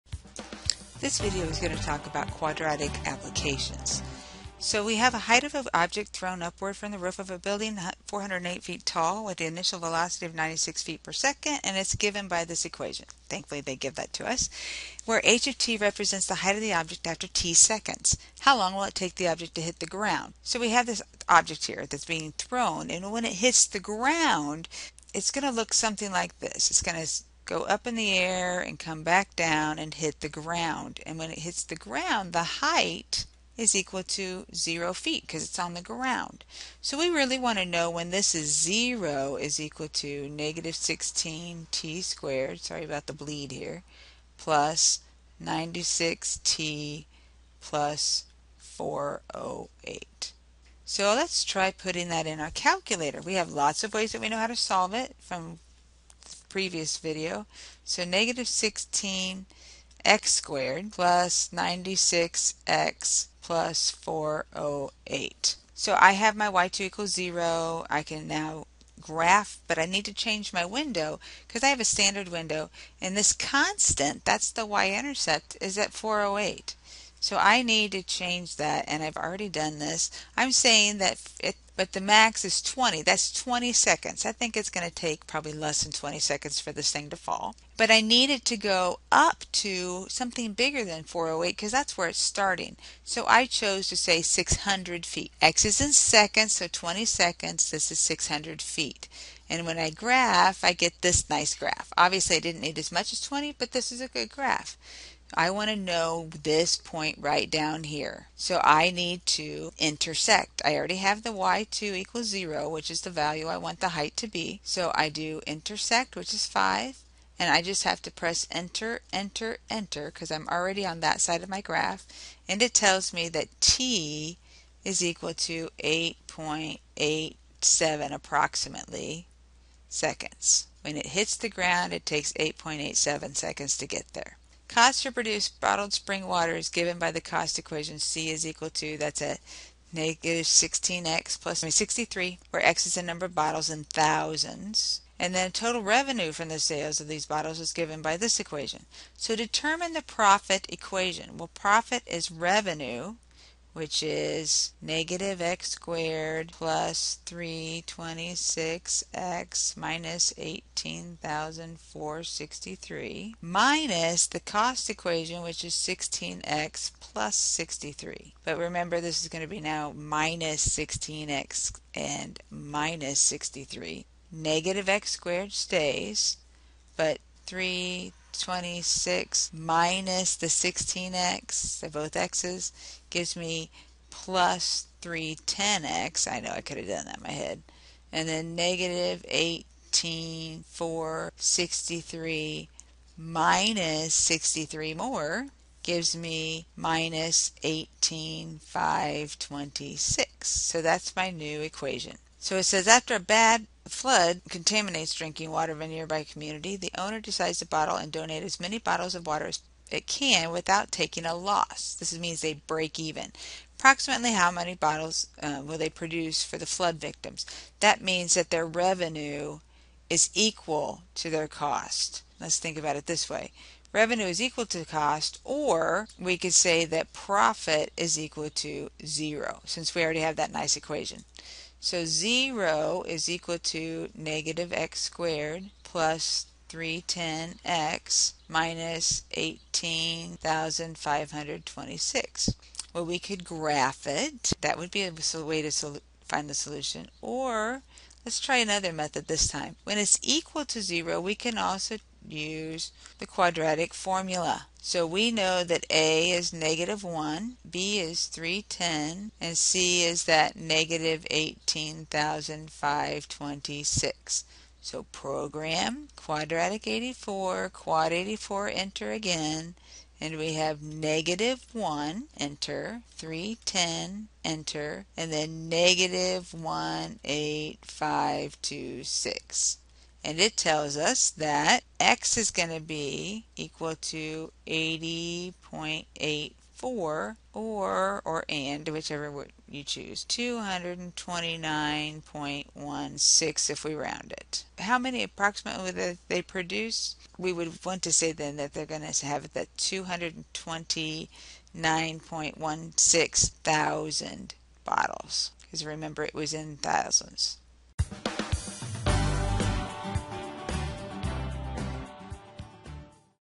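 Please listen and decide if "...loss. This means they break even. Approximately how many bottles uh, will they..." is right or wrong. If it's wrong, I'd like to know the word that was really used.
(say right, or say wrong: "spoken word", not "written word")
right.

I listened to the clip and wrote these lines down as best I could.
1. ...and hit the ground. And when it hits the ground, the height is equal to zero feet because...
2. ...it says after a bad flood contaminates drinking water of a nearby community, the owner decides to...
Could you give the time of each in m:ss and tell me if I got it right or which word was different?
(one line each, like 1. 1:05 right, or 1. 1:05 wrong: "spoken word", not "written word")
1. 0:29 right
2. 3:22 right.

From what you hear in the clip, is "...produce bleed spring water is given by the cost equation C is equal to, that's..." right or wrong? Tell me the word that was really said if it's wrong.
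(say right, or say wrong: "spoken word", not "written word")
wrong: "bottled", not "bleed".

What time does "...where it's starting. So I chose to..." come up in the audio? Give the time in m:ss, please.
1:31.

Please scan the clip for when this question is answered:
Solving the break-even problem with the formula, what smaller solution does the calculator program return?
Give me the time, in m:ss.
4:44.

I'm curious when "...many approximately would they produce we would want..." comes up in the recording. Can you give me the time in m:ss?
4:54.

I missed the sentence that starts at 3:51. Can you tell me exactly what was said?
So 0 is equal to negative x squared plus 310x minus 18,526.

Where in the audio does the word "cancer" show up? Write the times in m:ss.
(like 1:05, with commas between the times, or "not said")
not said.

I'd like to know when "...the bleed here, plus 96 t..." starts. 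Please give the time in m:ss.
0:43.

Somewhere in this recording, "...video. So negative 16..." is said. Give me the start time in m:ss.
0:56.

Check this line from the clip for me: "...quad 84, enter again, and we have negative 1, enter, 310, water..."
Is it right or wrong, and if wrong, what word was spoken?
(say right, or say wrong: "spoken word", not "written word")
wrong: "enter", not "water".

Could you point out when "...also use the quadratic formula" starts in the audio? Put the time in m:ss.
4:11.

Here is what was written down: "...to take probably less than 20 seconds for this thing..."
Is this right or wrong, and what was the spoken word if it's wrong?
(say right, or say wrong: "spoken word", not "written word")
right.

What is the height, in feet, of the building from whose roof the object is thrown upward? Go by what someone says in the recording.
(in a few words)
408 feet.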